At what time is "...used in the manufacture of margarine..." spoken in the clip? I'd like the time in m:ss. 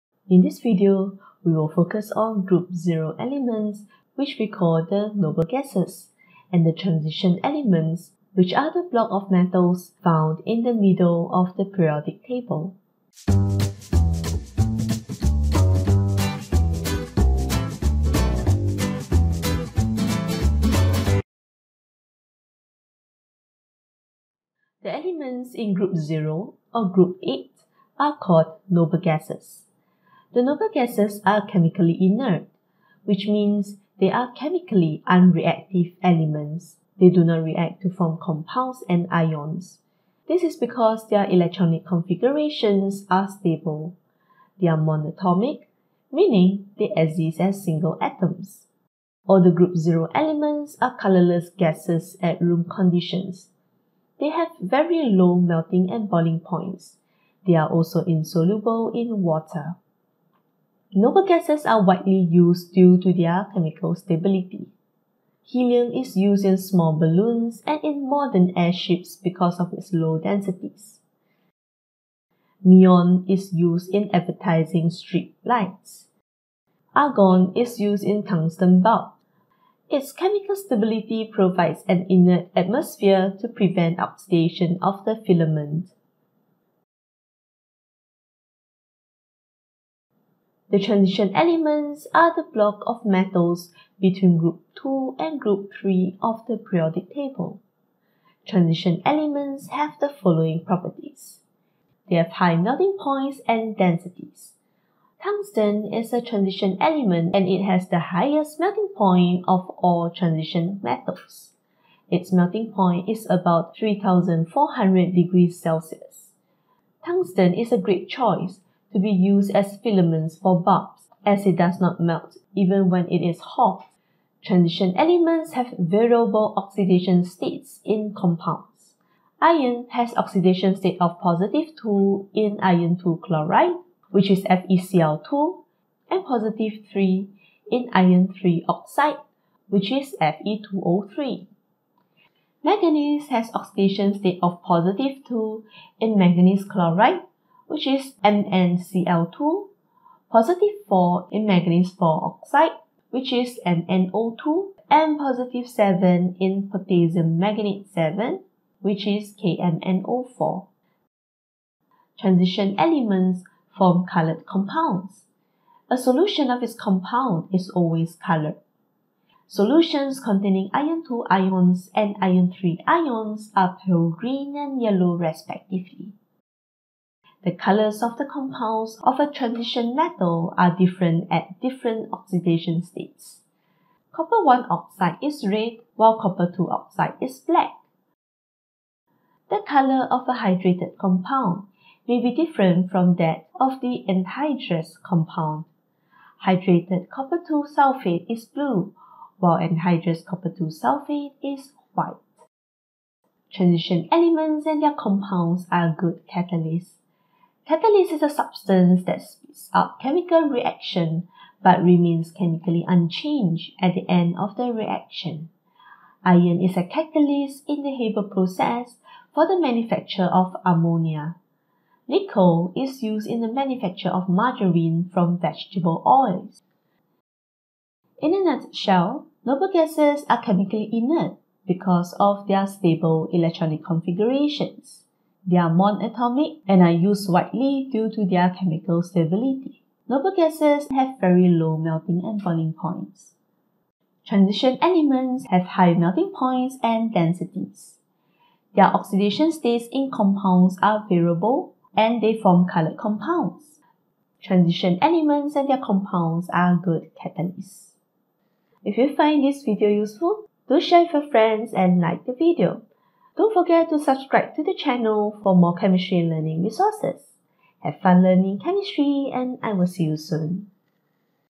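3:43.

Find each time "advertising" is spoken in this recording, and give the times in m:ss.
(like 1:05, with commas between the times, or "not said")
1:14.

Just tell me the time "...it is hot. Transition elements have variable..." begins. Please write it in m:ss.
2:03.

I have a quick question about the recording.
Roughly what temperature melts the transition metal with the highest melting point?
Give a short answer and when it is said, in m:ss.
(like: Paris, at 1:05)
3400 degrees Celsius, at 1:53.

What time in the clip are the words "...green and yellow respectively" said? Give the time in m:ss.
2:54.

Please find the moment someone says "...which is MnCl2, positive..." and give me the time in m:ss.
2:27.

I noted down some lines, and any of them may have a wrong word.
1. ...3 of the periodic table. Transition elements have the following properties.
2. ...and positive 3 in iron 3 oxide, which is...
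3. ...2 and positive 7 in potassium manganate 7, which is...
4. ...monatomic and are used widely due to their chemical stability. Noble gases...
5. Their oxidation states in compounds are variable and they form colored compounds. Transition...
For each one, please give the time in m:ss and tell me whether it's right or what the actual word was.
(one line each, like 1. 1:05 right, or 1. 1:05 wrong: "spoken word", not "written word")
1. 1:35 right
2. 2:16 right
3. 2:34 right
4. 3:55 right
5. 4:08 right.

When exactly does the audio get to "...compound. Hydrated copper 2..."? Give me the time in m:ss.
3:15.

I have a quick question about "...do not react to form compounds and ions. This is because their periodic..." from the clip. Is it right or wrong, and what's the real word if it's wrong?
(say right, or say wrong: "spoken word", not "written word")
wrong: "electronic", not "periodic".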